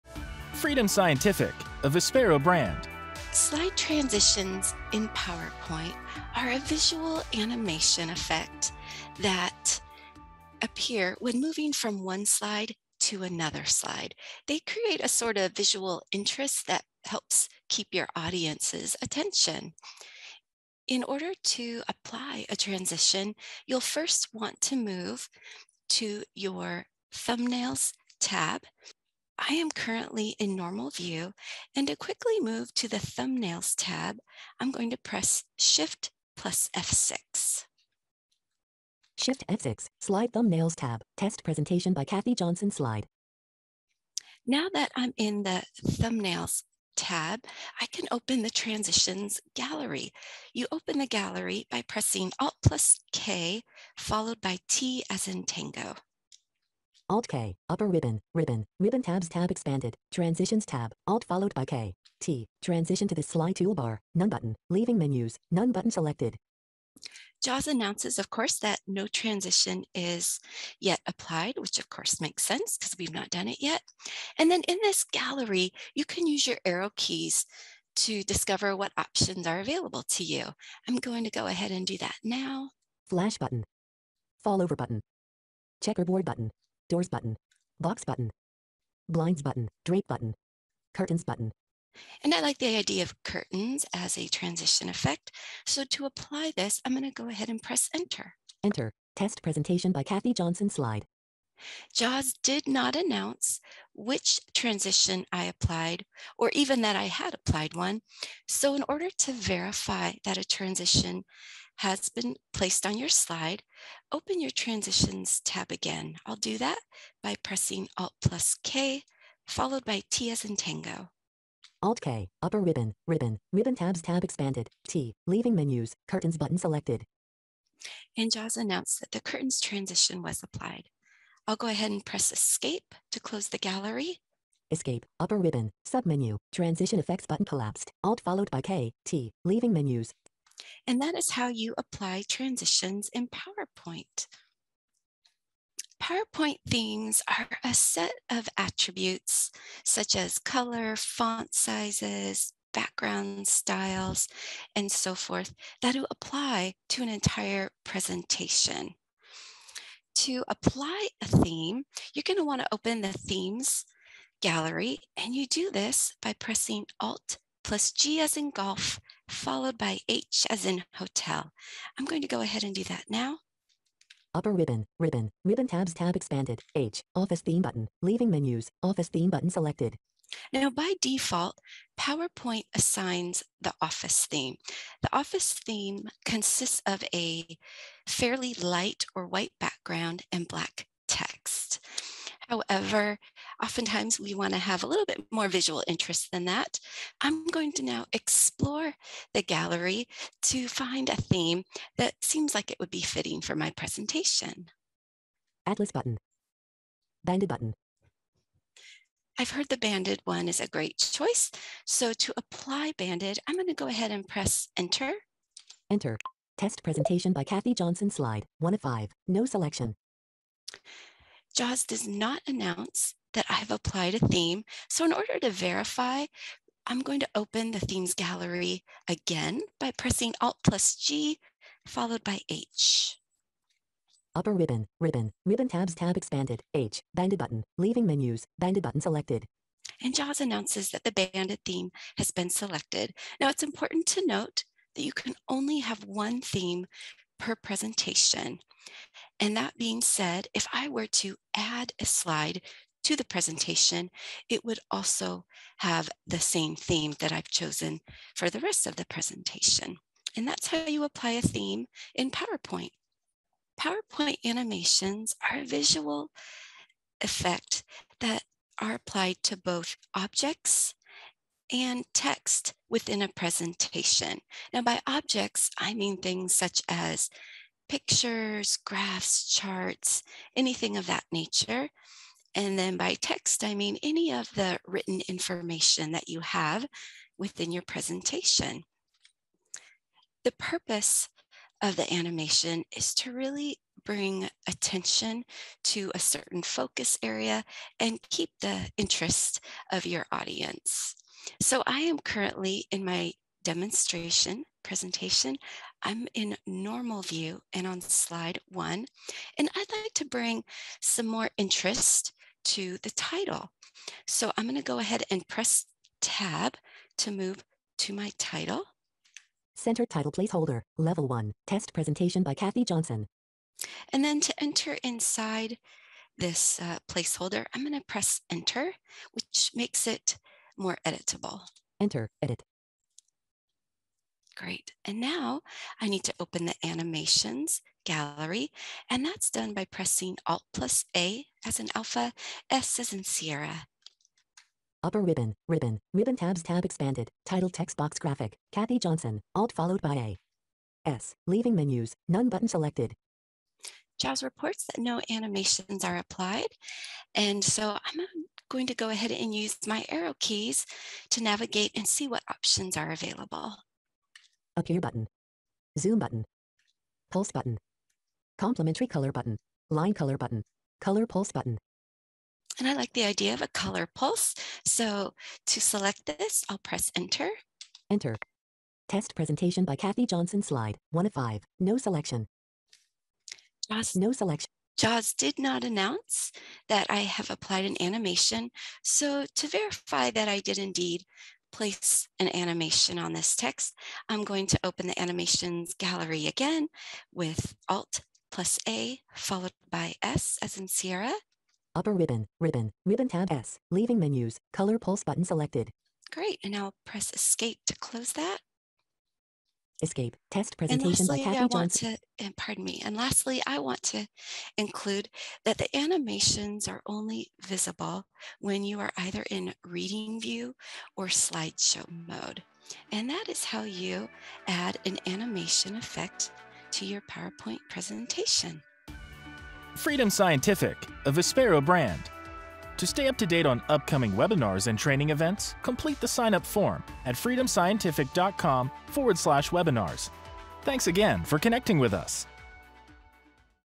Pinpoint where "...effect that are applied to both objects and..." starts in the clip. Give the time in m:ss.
4:27.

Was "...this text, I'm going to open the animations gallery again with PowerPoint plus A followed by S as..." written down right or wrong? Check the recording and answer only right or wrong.
wrong.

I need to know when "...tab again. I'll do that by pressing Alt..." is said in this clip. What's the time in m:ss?
1:55.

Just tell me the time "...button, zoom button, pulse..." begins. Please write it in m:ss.
6:05.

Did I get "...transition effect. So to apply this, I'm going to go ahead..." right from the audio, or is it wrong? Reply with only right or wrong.
right.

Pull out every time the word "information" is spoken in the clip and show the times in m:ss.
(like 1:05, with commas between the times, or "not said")
4:45.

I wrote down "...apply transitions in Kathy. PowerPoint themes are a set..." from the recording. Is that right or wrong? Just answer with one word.
wrong.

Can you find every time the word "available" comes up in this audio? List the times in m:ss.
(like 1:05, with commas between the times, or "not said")
1:19, 6:03.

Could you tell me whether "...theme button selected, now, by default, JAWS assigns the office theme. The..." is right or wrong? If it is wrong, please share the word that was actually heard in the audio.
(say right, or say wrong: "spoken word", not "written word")
wrong: "PowerPoint", not "JAWS".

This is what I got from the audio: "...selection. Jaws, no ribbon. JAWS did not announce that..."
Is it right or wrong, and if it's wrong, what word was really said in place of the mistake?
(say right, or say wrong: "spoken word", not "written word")
wrong: "selection", not "ribbon".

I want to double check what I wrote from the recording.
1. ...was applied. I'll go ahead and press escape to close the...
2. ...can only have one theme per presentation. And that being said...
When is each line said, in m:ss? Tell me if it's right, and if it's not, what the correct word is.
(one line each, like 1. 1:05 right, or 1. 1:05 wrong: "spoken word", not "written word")
1. 2:10 right
2. 4:05 right.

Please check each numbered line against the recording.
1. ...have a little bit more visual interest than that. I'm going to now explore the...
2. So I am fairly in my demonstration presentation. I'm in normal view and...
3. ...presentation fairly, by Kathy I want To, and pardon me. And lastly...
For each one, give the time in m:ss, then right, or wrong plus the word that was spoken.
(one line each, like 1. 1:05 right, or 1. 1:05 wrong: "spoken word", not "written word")
1. 3:14 right
2. 5:01 wrong: "currently", not "fairly"
3. 6:50 wrong: "lastly", not "fairly".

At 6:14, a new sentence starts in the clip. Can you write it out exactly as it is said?
So to select this, I'll press enter.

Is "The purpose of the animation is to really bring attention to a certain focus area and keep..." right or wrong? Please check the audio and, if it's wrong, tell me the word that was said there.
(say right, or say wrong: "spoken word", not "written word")
right.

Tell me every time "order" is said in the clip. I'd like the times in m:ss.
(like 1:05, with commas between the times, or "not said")
0:21, 1:48, 3:45.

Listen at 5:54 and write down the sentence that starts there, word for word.
JAWS reports that no animations are applied.